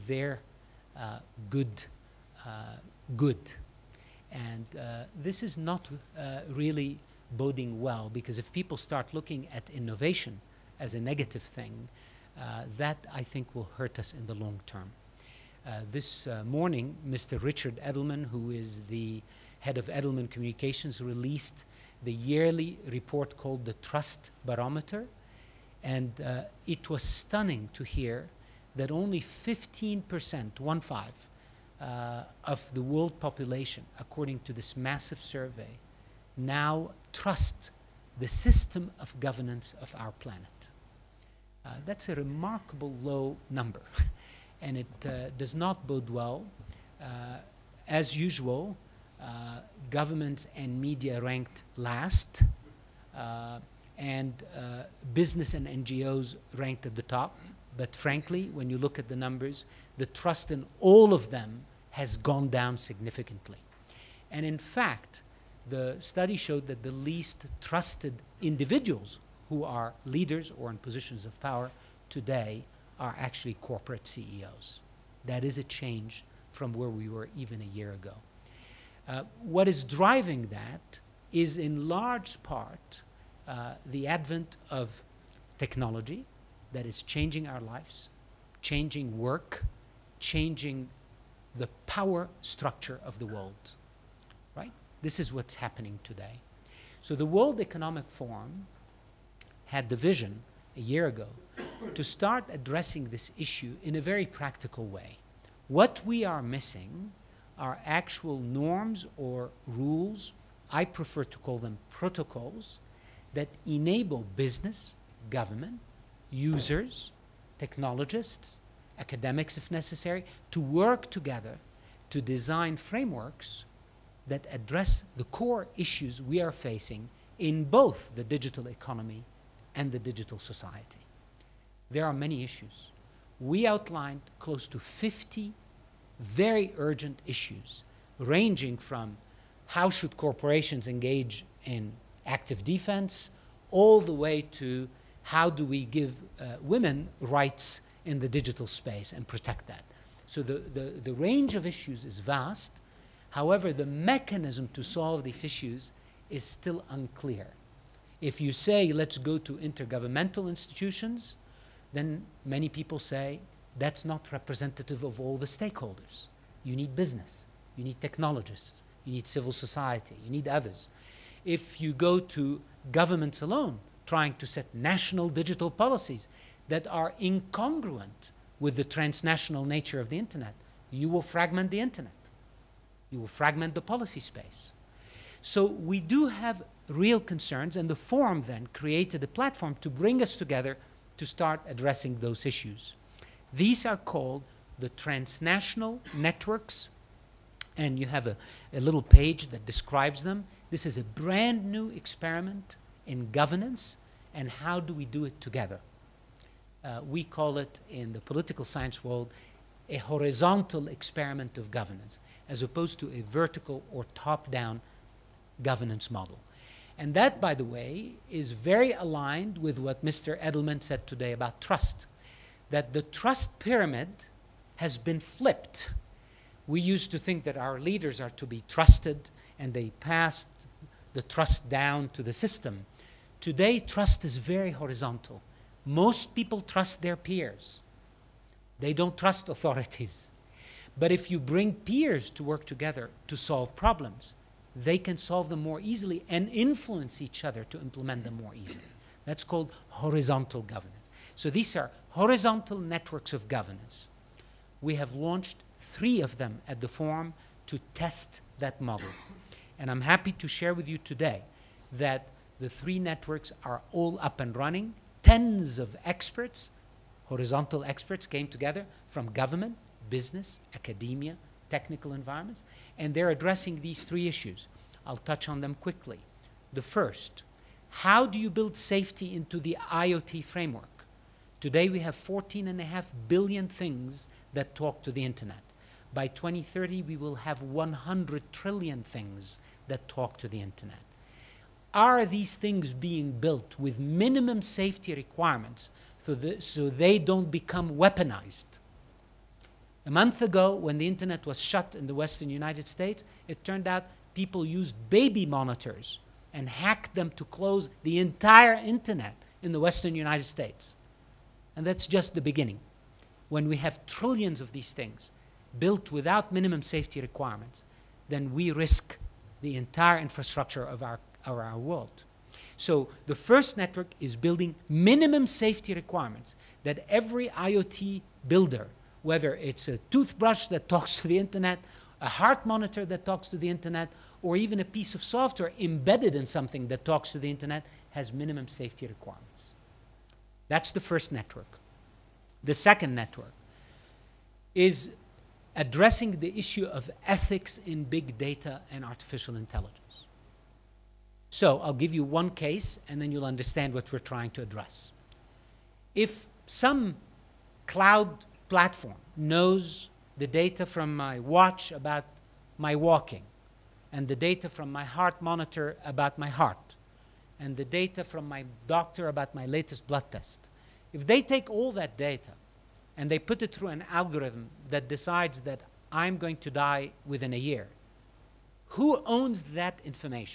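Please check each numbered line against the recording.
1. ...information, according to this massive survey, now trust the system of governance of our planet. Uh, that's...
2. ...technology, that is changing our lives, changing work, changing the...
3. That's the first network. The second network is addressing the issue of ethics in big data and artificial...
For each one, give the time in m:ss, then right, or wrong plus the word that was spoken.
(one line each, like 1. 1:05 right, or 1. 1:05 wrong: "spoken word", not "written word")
1. 0:33 wrong: "population", not "information"
2. 1:25 right
3. 5:40 right.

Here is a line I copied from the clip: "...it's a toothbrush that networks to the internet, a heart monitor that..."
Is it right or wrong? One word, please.
wrong.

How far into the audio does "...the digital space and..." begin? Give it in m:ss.
2:28.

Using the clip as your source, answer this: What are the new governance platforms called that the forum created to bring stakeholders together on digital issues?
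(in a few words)
transnational networks.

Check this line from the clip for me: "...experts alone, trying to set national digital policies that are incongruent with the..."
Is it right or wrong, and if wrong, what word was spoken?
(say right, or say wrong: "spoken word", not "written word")
wrong: "governments", not "experts".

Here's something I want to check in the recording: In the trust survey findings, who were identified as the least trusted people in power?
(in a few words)
corporate CEOs.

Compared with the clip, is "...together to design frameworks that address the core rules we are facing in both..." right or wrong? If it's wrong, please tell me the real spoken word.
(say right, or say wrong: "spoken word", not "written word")
wrong: "issues", not "rules".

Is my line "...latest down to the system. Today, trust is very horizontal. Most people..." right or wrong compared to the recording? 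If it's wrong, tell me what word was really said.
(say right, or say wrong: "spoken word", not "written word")
wrong: "trust", not "latest".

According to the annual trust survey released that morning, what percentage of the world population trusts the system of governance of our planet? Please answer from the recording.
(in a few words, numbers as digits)
15%.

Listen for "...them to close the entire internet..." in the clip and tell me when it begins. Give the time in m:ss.
5:07.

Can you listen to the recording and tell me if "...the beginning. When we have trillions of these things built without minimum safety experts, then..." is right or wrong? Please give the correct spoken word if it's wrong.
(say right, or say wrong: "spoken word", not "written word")
wrong: "requirements", not "experts".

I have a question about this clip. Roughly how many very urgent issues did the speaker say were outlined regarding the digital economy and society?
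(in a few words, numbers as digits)
50.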